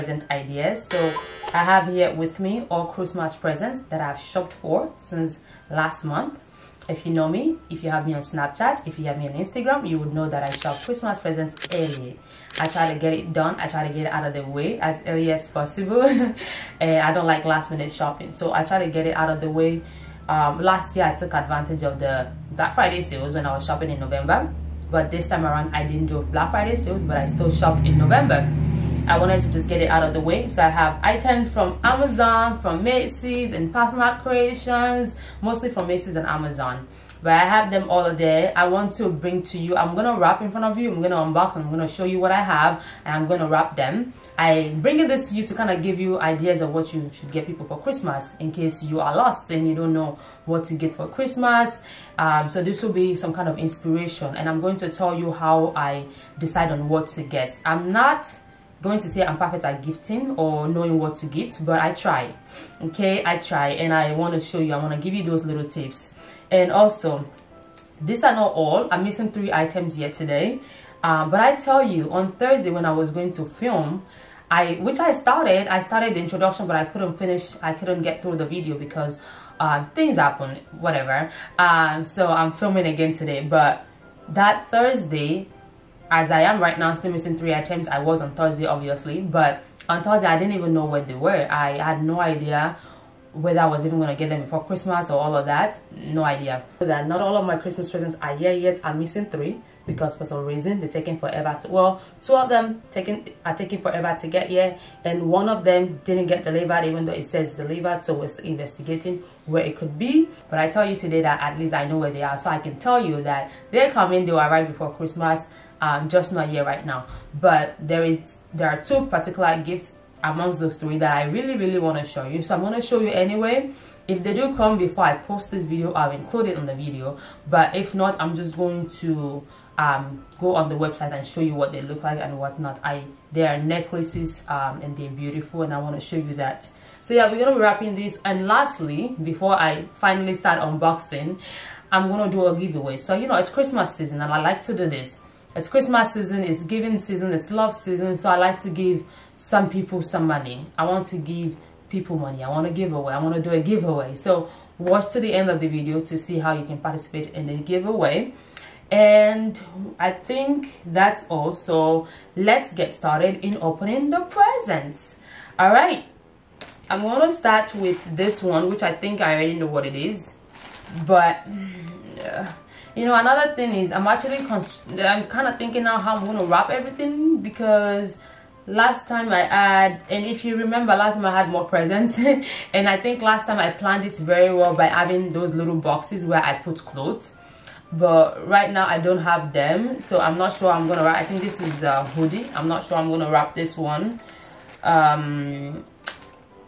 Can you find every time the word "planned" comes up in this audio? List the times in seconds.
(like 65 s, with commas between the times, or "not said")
183 s.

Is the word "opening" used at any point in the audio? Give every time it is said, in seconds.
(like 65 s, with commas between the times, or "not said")
163 s.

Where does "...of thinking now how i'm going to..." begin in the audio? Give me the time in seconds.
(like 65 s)
175 s.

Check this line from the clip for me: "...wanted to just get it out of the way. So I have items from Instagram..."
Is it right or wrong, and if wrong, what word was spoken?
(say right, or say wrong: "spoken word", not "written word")
wrong: "Amazon", not "Instagram".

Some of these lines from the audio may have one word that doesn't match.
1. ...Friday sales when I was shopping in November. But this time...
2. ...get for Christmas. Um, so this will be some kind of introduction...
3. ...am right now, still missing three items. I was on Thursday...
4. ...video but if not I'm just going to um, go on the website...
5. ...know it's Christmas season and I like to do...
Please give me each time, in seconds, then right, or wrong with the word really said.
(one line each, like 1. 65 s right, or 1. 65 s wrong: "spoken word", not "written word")
1. 22 s right
2. 50 s wrong: "inspiration", not "introduction"
3. 86 s right
4. 126 s right
5. 143 s right.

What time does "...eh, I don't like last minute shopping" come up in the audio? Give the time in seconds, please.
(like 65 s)
16 s.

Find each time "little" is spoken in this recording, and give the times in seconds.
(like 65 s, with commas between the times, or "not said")
65 s, 185 s.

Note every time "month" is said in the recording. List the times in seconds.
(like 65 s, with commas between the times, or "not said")
6 s.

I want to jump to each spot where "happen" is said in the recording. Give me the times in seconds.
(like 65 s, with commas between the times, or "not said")
80 s.